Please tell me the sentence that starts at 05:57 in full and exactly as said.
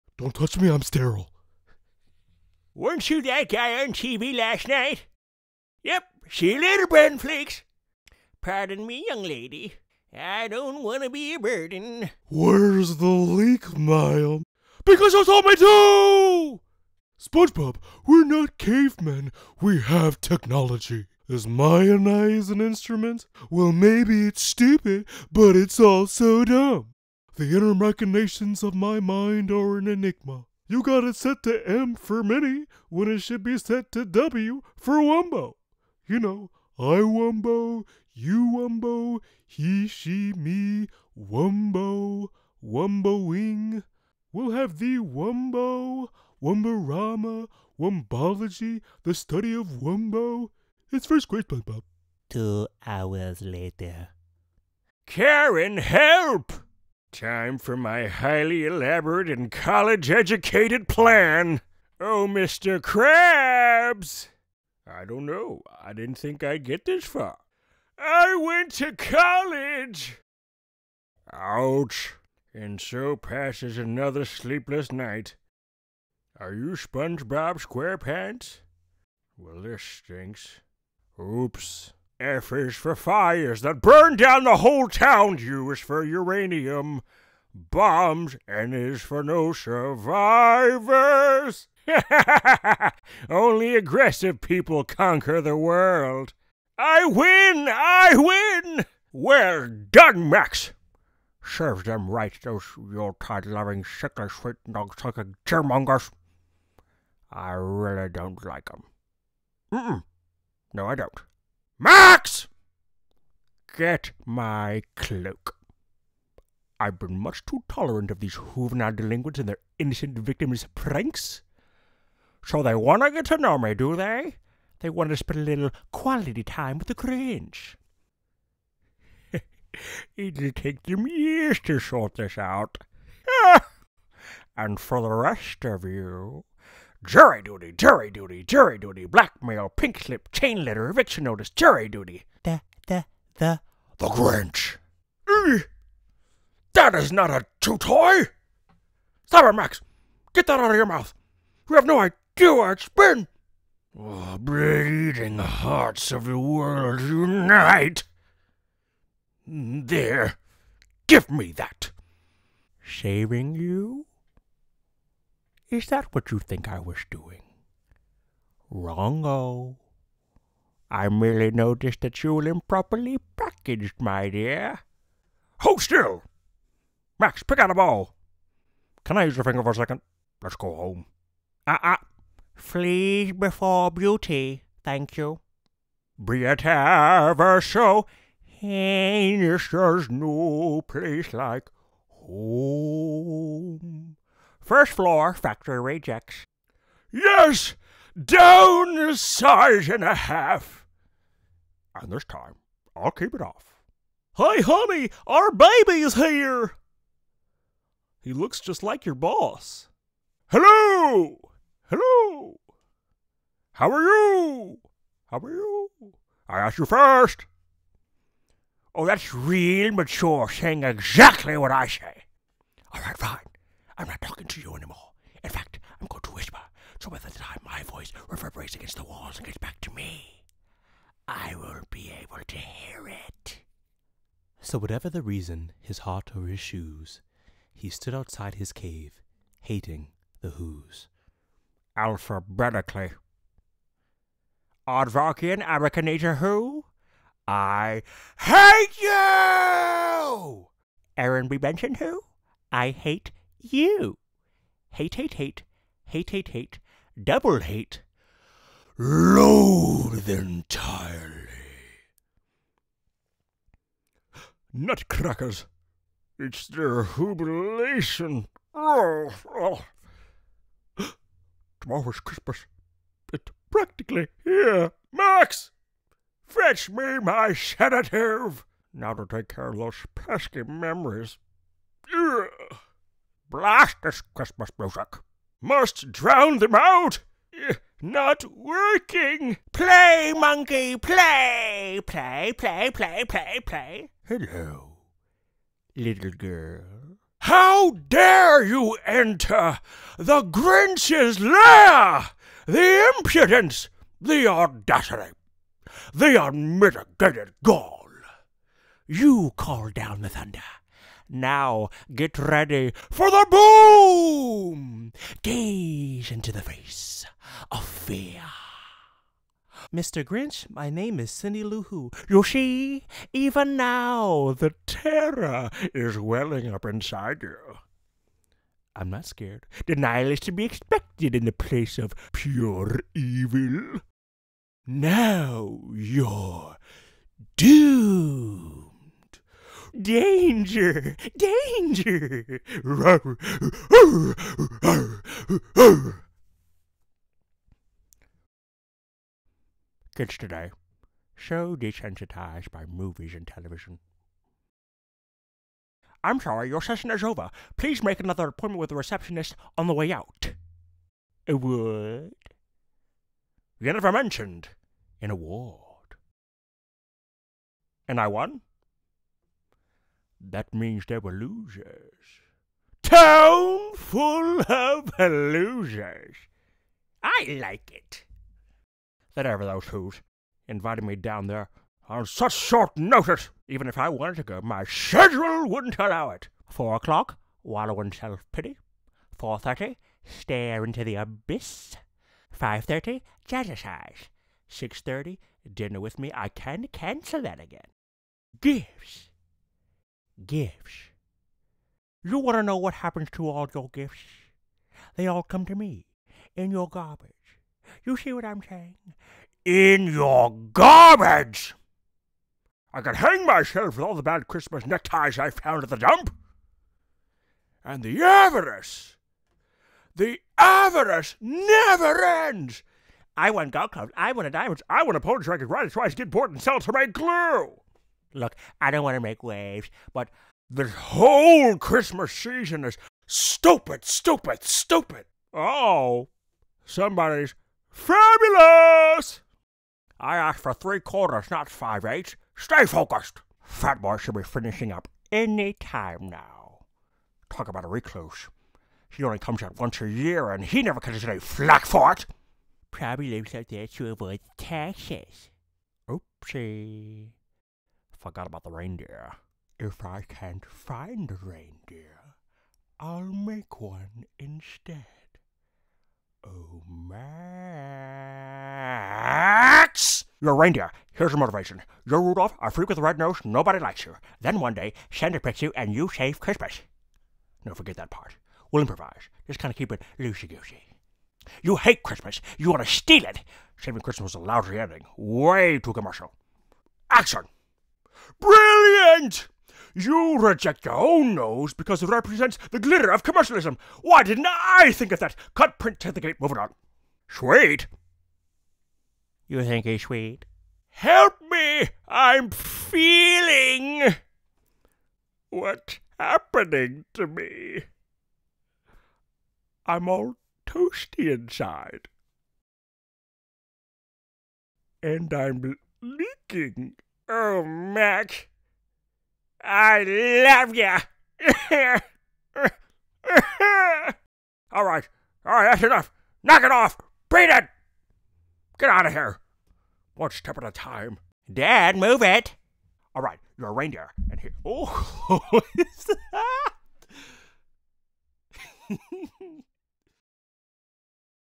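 Please make another appointment with the receptionist on the way out.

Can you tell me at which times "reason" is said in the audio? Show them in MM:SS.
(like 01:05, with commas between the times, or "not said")
03:55.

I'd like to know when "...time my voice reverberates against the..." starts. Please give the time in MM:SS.
03:47.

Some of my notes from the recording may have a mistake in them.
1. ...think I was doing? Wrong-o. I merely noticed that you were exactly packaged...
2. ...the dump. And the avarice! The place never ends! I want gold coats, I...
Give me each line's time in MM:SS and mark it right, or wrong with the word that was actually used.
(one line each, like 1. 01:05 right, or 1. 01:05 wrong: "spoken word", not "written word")
1. 02:46 wrong: "improperly", not "exactly"
2. 06:55 wrong: "avarice", not "place".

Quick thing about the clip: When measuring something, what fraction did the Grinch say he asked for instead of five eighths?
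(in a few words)
3/4.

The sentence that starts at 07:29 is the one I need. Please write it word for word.
He only comes out once a year, and he never catches any flack for it.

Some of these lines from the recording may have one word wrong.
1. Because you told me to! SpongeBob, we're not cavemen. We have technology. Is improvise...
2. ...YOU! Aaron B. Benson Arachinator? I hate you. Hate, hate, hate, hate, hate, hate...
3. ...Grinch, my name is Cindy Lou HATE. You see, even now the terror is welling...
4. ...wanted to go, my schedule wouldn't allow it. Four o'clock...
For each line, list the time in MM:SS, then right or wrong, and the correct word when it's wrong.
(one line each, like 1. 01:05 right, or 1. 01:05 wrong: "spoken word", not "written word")
1. 00:14 wrong: "mayonnaise", not "improvise"
2. 04:08 wrong: "Who", not "Arachinator"
3. 05:20 wrong: "Who", not "HATE"
4. 06:24 right.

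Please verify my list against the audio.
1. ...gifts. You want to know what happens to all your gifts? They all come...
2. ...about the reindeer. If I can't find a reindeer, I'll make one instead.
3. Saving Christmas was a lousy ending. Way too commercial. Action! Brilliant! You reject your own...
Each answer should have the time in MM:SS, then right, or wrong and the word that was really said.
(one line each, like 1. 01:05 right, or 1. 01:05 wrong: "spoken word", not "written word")
1. 06:40 right
2. 07:38 right
3. 08:03 right.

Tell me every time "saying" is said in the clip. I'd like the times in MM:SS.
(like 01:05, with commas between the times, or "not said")
03:40, 06:48.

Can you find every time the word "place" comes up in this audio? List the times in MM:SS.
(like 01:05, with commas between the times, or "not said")
03:10, 05:31.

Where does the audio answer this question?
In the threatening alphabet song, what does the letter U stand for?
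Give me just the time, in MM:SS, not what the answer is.
01:25.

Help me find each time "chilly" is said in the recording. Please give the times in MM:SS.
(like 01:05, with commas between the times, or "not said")
not said.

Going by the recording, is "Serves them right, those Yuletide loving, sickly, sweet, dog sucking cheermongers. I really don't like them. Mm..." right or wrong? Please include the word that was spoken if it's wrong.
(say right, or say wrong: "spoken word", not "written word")
right.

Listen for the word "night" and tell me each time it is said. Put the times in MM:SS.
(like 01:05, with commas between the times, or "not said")
00:04, 01:14.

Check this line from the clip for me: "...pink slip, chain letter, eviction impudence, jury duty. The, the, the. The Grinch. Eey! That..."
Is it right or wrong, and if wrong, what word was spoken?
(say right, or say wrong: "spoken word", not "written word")
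wrong: "notice", not "impudence".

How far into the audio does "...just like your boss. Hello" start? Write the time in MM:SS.
03:28.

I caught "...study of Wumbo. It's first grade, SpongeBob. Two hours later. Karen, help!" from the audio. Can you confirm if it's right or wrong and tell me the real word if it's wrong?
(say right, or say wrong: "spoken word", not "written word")
right.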